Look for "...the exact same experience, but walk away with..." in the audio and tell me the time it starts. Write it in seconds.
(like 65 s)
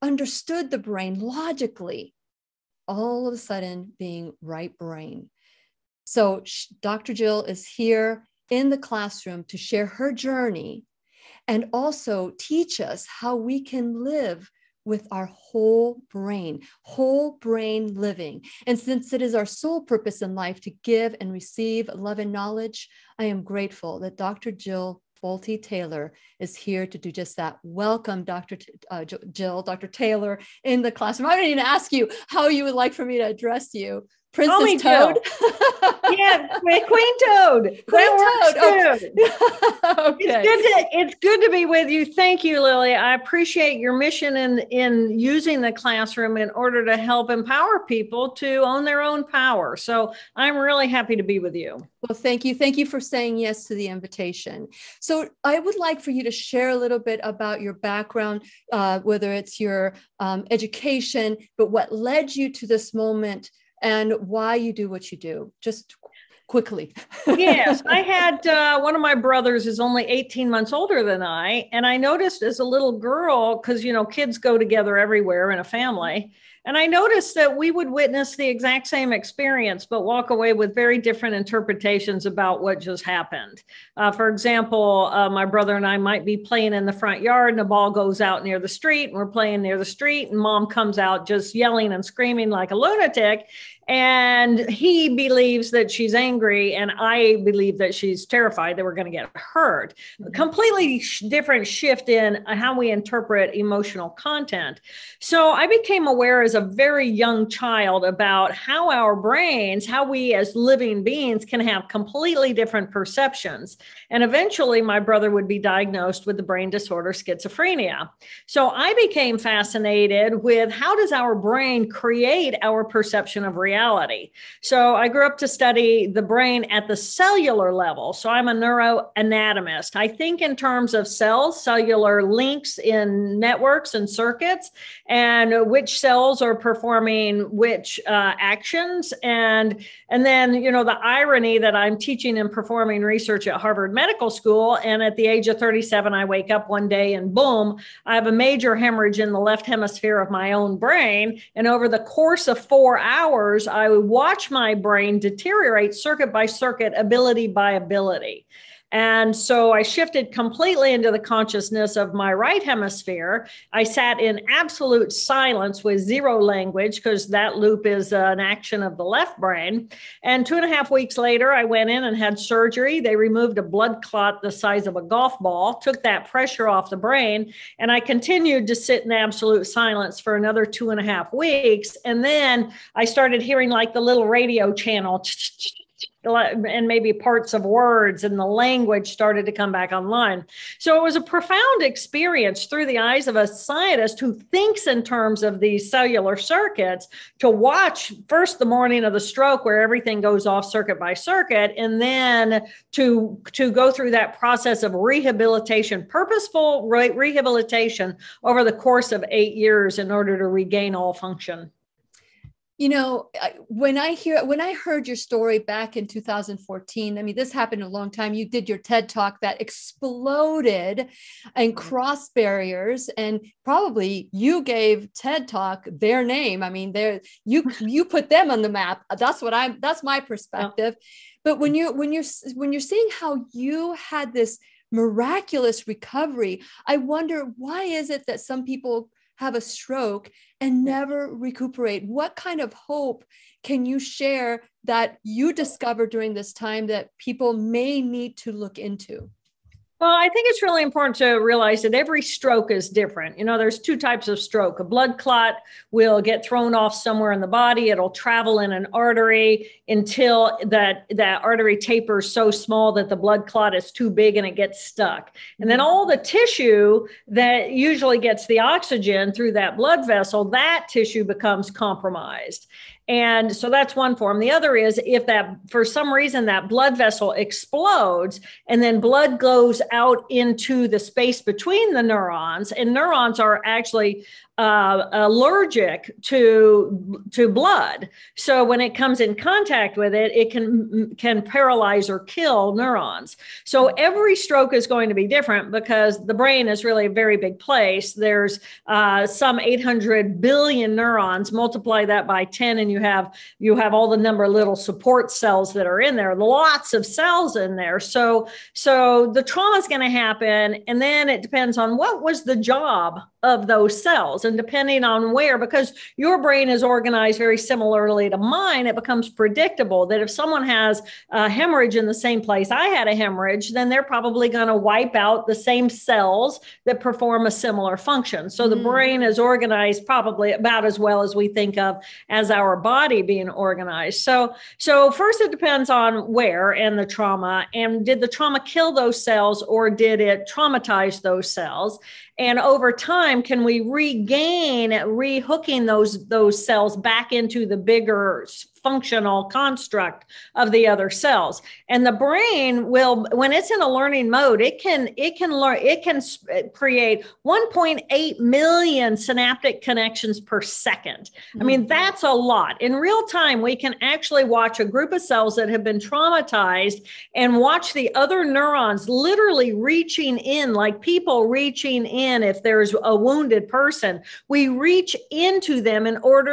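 78 s.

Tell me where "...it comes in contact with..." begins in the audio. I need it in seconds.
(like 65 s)
288 s.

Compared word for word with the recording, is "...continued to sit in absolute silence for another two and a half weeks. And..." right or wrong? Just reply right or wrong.
right.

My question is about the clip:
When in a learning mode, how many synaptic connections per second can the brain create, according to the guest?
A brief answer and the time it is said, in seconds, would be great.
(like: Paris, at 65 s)
1.8 million, at 357 s.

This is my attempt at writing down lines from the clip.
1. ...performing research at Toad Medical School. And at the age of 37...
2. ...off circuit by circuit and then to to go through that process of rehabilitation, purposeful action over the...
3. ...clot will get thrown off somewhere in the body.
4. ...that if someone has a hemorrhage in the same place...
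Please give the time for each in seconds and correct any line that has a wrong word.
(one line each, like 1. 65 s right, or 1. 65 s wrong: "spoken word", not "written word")
1. 142 s wrong: "Harvard", not "Toad"
2. 200 s wrong: "rehabilitation", not "action"
3. 255 s right
4. 320 s right.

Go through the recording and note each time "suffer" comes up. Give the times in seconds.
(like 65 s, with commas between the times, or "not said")
not said.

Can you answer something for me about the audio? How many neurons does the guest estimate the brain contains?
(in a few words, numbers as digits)
800 billion.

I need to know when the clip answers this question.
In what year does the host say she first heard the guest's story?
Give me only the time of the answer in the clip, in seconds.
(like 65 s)
216 s.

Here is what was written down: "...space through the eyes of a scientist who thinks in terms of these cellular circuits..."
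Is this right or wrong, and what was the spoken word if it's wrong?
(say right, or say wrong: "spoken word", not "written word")
wrong: "experience", not "space".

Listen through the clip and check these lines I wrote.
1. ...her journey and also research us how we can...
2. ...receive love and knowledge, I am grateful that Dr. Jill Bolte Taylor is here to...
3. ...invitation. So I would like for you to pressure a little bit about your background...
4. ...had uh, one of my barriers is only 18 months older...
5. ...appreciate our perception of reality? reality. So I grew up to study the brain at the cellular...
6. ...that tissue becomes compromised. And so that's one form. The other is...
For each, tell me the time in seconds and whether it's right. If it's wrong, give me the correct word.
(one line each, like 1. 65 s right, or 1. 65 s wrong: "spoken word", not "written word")
1. 9 s wrong: "teach", not "research"
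2. 21 s right
3. 53 s wrong: "share", not "pressure"
4. 67 s wrong: "brothers", not "barriers"
5. 121 s wrong: "create", not "appreciate"
6. 270 s right.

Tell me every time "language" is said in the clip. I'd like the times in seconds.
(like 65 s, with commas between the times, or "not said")
166 s, 188 s.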